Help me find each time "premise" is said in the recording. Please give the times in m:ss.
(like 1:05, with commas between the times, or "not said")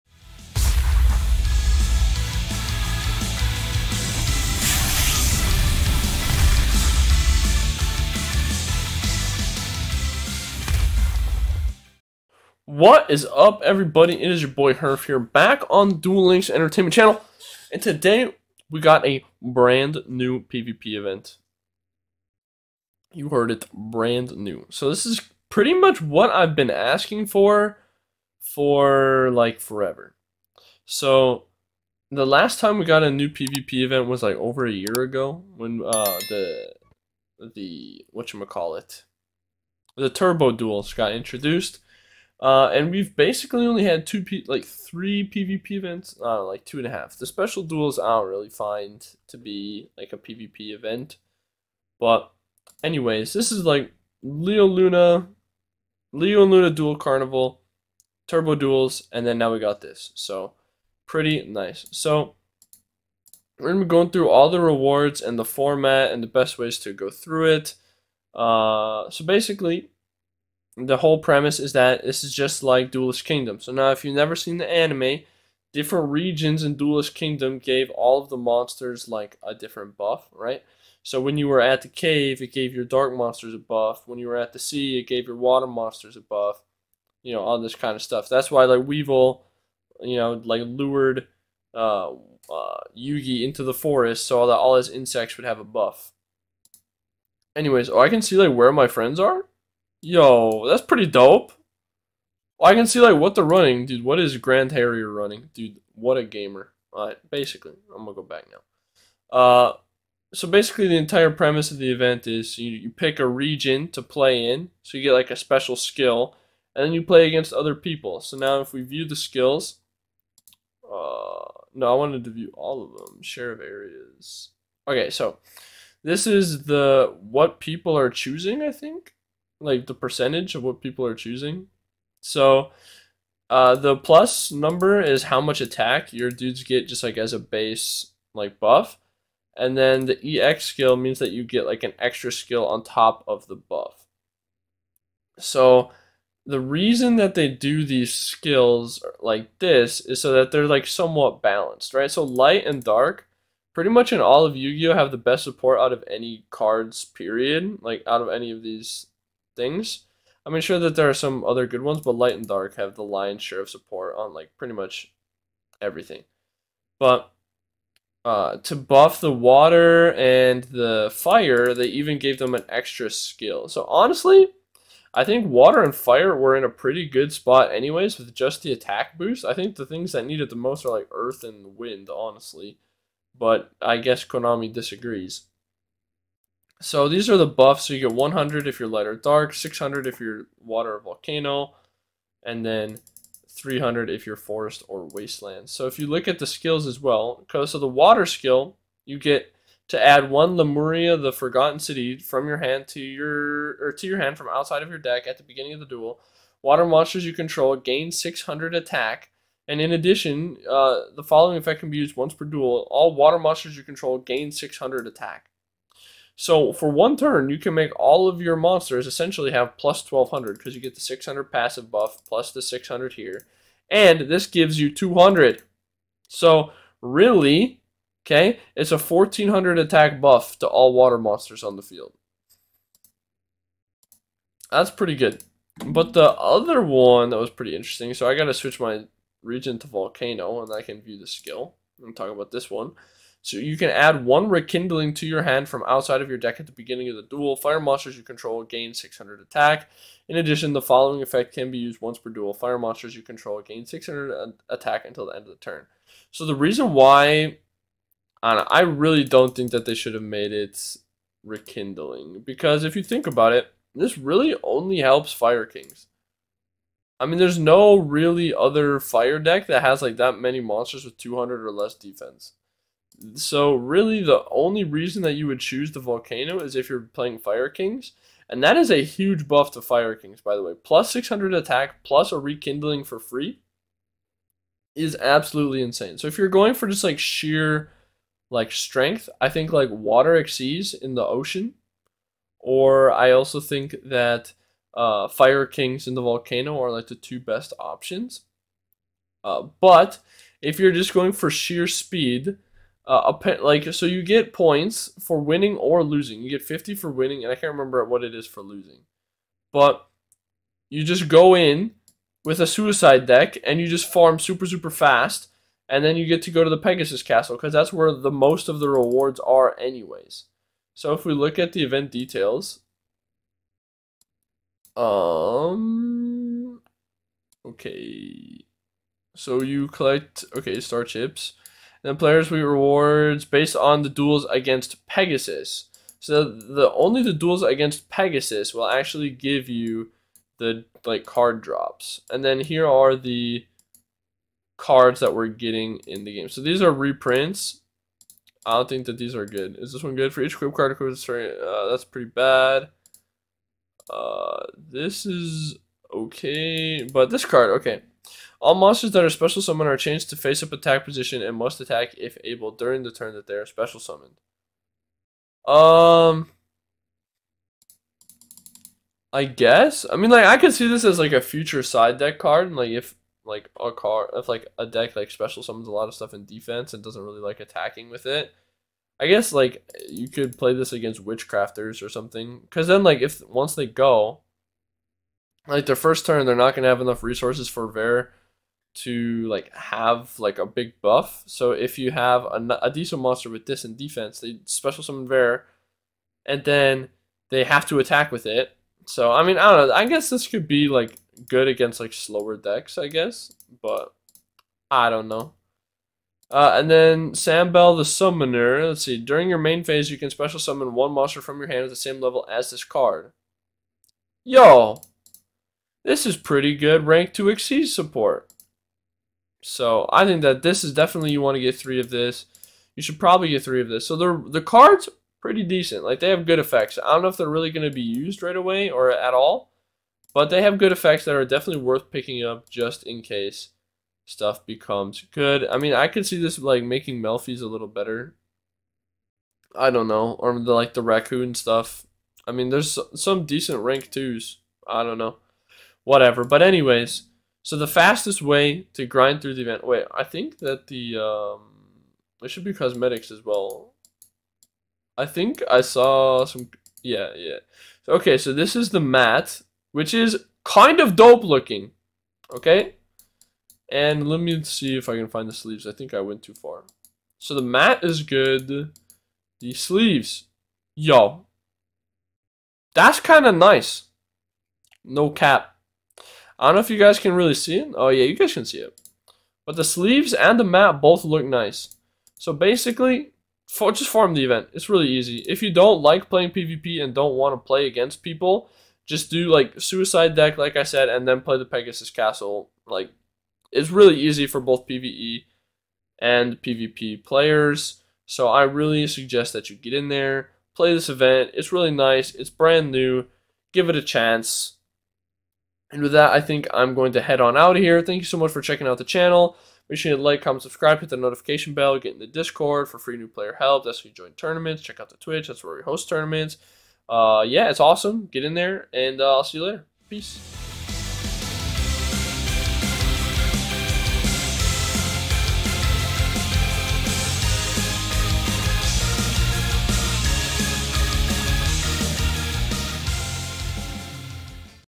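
1:11, 1:51.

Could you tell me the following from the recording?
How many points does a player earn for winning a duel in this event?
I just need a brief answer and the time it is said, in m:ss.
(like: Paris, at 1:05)
50, at 5:06.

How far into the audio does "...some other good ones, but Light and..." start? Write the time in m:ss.
2:41.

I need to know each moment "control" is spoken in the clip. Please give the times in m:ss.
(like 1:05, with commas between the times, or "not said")
3:27, 3:33, 4:08, 4:13.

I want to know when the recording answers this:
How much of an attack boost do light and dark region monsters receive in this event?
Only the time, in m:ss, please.
3:08.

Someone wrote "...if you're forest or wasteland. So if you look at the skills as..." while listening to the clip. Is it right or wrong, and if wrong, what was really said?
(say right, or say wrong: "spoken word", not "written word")
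right.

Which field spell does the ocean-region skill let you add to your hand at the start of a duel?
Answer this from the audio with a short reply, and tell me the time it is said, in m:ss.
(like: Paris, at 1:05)
Lemuria, the Forgotten City, at 3:20.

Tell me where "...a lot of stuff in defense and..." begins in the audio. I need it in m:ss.
6:15.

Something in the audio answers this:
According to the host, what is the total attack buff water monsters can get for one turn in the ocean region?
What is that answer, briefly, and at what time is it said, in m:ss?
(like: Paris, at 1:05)
1400, at 3:48.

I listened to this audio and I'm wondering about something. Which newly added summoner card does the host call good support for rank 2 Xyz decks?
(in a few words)
Sambell the Summoner.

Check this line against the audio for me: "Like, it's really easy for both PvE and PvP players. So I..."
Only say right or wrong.
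right.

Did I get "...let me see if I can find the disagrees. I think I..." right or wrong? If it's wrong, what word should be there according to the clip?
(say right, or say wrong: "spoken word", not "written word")
wrong: "sleeves", not "disagrees".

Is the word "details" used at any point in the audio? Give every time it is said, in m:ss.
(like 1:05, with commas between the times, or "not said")
5:22.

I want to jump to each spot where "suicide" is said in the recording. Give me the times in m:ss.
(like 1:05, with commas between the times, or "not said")
5:12, 8:09.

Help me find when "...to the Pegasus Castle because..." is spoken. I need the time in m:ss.
5:16.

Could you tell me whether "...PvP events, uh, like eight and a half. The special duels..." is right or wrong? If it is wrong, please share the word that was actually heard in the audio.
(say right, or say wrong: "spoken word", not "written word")
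wrong: "two", not "eight".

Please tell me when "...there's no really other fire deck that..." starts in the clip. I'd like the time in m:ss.
4:27.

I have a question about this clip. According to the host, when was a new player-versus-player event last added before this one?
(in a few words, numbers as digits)
over a year ago.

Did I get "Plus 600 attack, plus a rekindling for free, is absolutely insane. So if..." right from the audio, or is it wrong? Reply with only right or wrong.
right.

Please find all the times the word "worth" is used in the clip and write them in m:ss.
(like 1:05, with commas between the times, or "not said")
7:11.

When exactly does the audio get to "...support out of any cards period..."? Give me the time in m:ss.
2:35.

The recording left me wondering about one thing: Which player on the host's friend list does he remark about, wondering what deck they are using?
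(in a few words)
Grand Harrier.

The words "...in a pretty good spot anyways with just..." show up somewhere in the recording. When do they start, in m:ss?
2:56.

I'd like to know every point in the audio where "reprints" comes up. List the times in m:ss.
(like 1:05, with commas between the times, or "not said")
5:46.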